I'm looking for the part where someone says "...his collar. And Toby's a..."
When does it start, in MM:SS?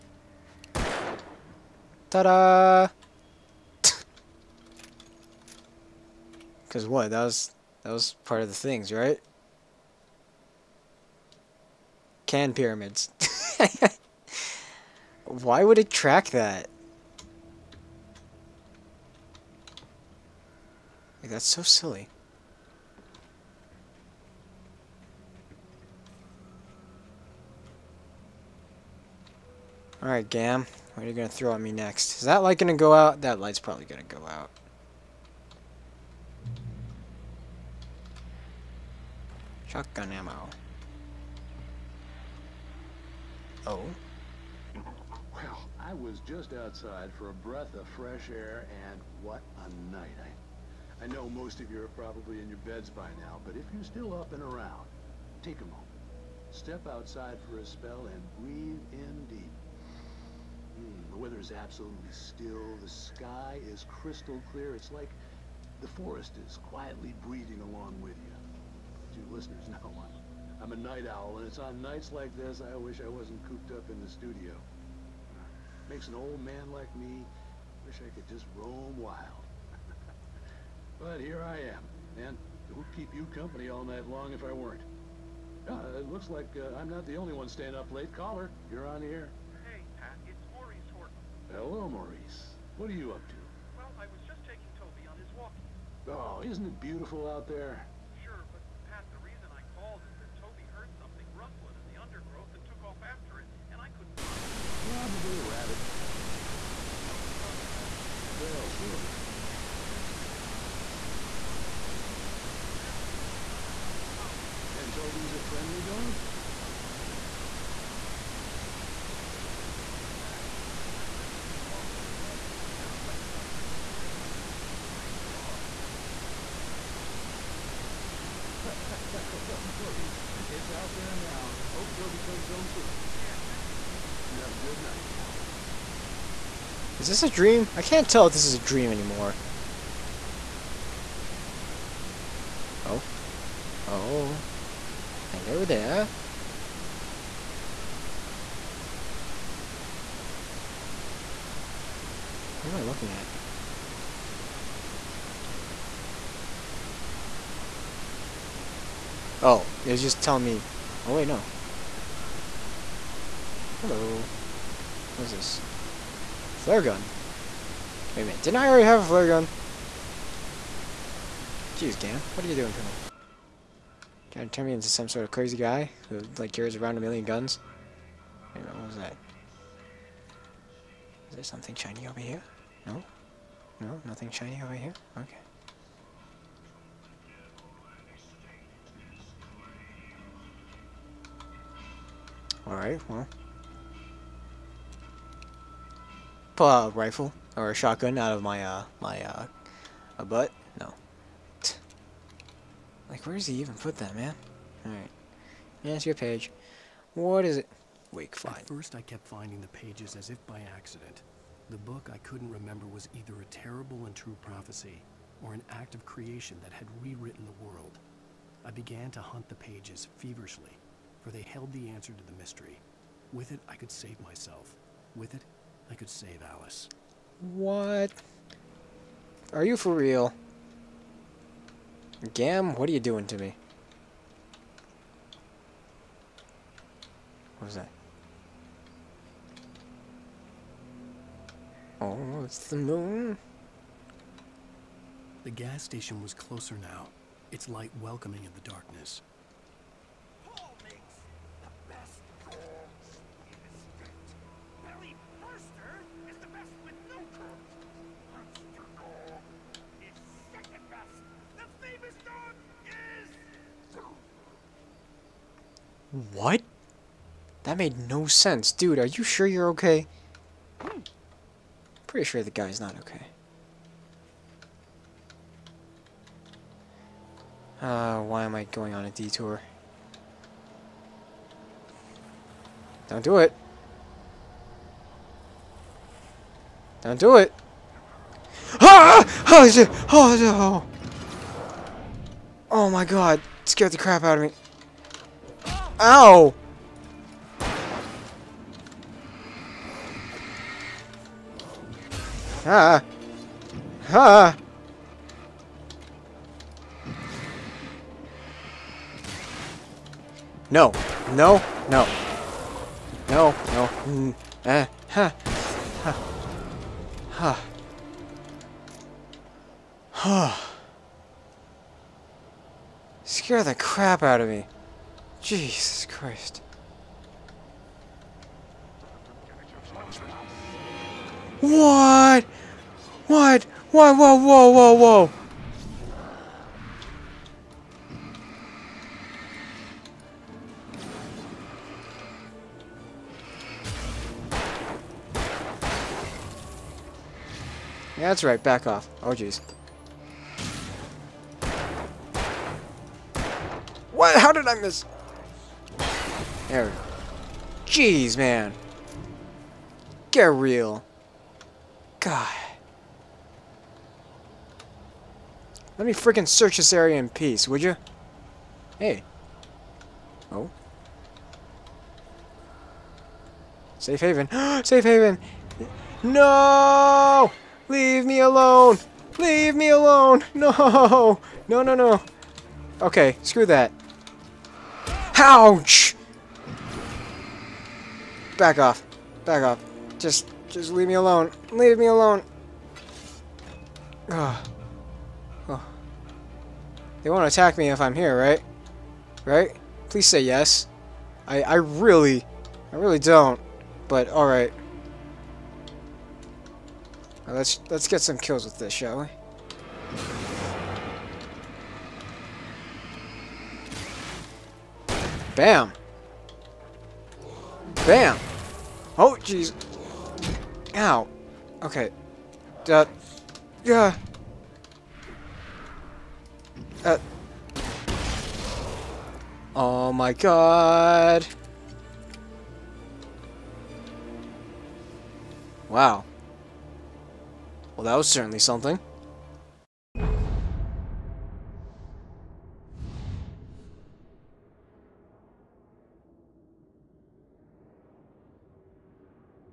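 01:53.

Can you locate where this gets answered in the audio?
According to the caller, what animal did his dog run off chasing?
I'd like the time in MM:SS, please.
01:45.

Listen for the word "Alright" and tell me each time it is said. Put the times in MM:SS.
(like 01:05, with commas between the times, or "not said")
00:29, 03:12.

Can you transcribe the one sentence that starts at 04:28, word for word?
Dude, are you sure you're okay?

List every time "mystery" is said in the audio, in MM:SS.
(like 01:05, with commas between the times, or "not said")
03:42.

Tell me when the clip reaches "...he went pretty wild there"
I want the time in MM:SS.
02:03.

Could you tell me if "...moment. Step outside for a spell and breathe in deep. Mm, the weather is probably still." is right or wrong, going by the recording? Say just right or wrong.
wrong.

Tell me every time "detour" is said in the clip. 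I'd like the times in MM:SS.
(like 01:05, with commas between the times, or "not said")
04:39.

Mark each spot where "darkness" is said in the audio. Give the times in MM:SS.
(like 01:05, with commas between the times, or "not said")
04:08.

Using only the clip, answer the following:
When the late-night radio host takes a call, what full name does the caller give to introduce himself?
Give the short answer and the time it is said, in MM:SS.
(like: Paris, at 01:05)
Maurice Horton, at 01:30.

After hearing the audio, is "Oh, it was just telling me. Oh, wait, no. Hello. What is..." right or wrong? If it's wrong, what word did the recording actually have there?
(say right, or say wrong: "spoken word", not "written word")
right.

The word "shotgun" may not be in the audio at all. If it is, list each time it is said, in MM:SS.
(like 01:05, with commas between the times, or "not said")
00:39, 03:17.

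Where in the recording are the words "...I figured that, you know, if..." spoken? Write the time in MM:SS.
01:49.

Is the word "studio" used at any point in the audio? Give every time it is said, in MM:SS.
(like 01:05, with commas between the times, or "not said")
01:14.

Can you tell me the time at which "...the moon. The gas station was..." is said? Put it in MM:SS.
04:02.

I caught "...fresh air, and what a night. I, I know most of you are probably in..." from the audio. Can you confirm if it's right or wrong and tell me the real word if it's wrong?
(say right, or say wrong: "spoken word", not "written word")
right.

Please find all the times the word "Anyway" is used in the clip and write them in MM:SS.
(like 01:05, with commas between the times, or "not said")
01:49.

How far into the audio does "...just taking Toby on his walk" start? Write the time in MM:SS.
01:34.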